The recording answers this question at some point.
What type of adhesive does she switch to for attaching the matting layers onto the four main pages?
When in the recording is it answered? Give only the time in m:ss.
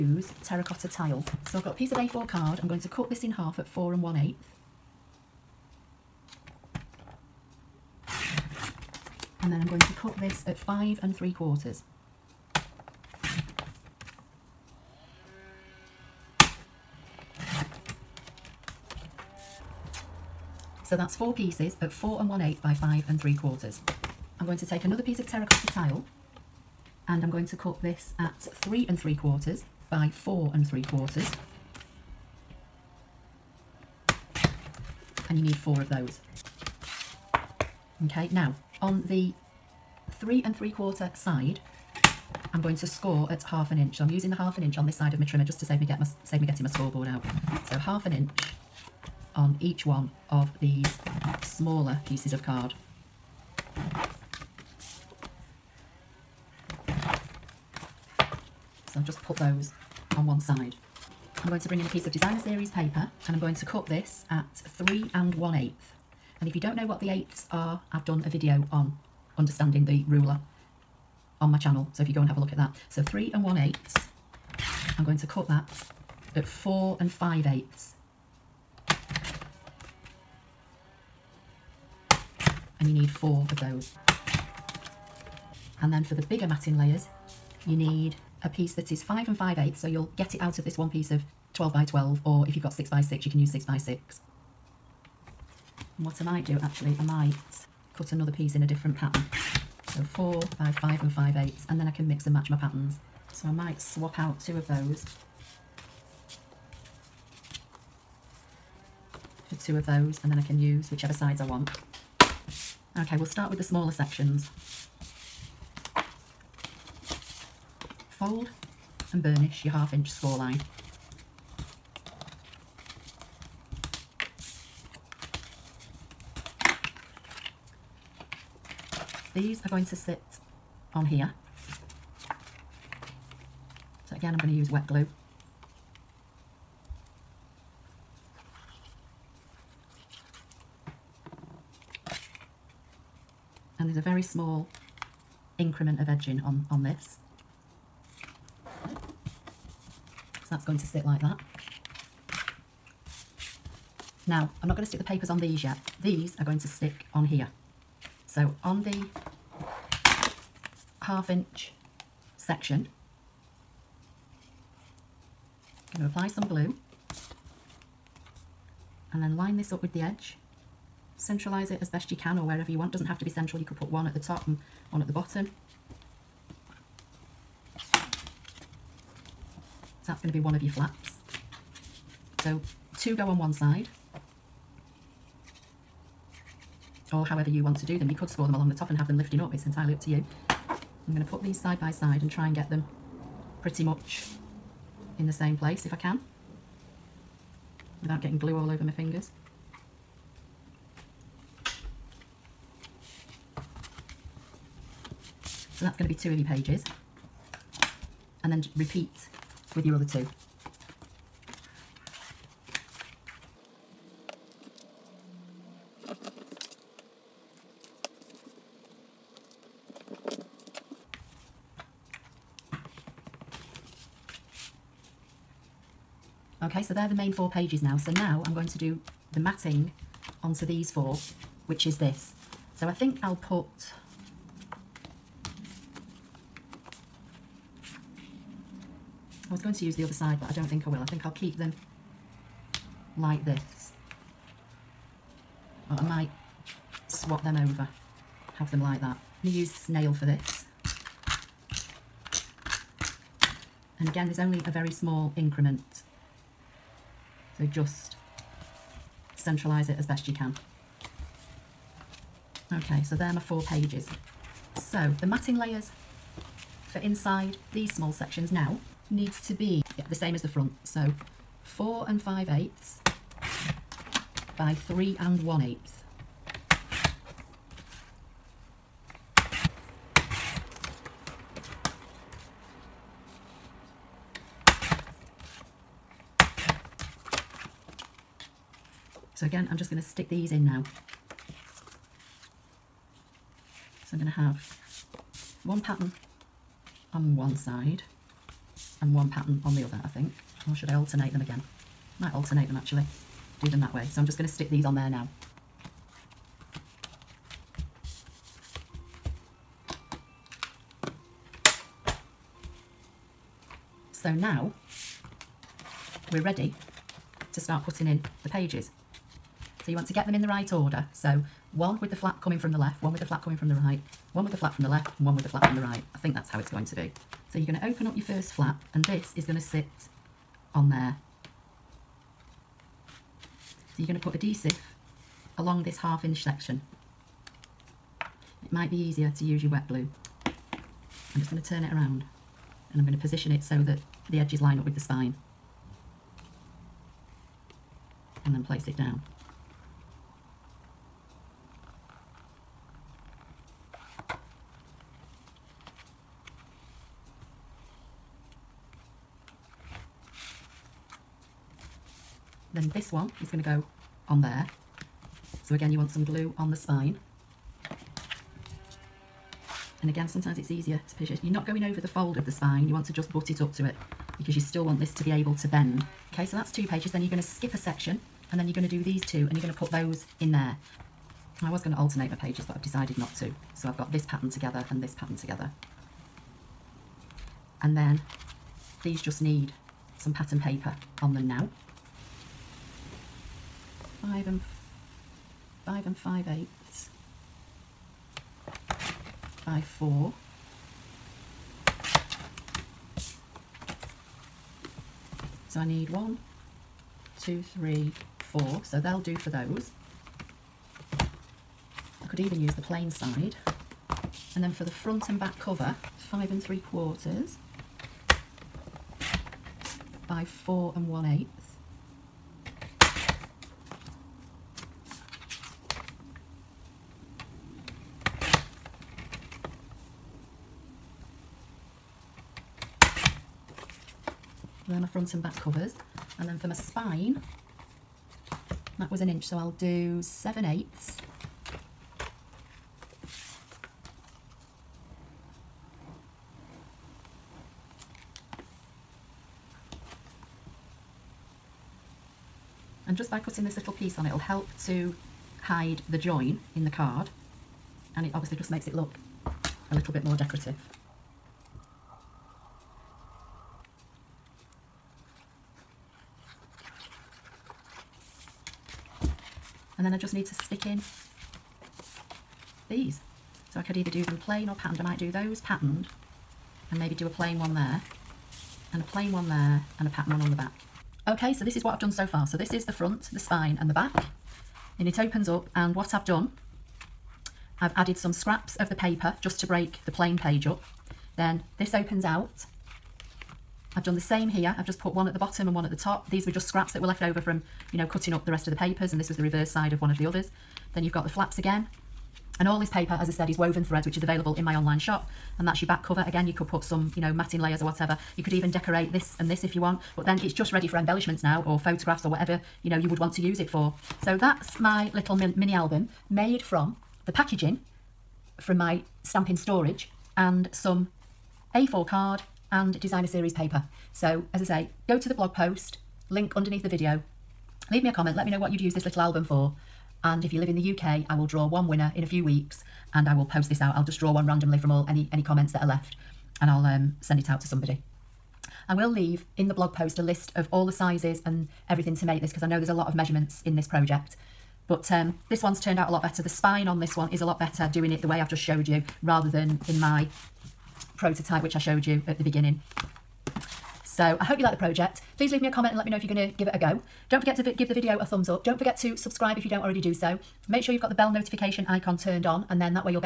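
4:09.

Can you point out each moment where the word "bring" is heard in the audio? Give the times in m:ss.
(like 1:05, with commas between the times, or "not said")
1:01.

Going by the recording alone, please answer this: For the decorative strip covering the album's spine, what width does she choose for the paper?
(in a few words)
7/8 inch.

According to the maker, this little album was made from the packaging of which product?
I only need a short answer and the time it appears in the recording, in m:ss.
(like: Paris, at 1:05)
Stampin storage, at 8:39.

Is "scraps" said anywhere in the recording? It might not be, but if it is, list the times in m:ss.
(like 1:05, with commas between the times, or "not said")
8:08, 8:16.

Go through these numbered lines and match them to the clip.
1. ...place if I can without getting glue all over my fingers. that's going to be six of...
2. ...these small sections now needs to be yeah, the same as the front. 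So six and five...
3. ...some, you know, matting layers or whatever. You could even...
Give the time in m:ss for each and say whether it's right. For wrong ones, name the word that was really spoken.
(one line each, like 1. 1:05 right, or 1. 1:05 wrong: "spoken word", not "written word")
1. 3:15 wrong: "two", not "six"
2. 4:27 wrong: "four", not "six"
3. 8:26 right.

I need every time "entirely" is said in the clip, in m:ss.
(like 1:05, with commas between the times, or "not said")
3:09.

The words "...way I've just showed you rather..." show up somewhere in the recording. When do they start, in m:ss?
9:08.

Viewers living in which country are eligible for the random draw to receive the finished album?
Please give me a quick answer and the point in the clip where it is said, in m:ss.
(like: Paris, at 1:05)
UK, at 8:50.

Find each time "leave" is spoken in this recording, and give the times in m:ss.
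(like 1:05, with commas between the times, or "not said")
8:47, 8:59, 9:15.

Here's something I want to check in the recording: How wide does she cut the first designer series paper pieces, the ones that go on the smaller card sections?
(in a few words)
3 and 1/8.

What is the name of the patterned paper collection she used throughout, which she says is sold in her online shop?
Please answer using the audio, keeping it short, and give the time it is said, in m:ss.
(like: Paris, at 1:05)
Woven threads, at 8:23.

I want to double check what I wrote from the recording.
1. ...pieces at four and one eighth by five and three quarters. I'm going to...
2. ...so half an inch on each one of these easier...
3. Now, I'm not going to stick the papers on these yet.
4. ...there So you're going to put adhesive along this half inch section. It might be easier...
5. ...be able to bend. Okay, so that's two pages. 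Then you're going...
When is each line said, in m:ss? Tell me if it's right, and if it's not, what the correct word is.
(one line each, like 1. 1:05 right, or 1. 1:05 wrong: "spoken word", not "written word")
1. 0:21 right
2. 0:47 wrong: "smaller", not "easier"
3. 2:34 right
4. 5:30 right
5. 6:15 right.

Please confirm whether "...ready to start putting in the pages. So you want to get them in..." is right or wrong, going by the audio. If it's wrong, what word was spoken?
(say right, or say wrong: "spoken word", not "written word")
right.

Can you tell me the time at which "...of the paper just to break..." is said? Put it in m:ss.
8:08.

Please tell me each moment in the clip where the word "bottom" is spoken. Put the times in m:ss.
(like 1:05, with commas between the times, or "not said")
2:55, 8:15.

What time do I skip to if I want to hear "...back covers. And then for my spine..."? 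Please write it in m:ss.
7:15.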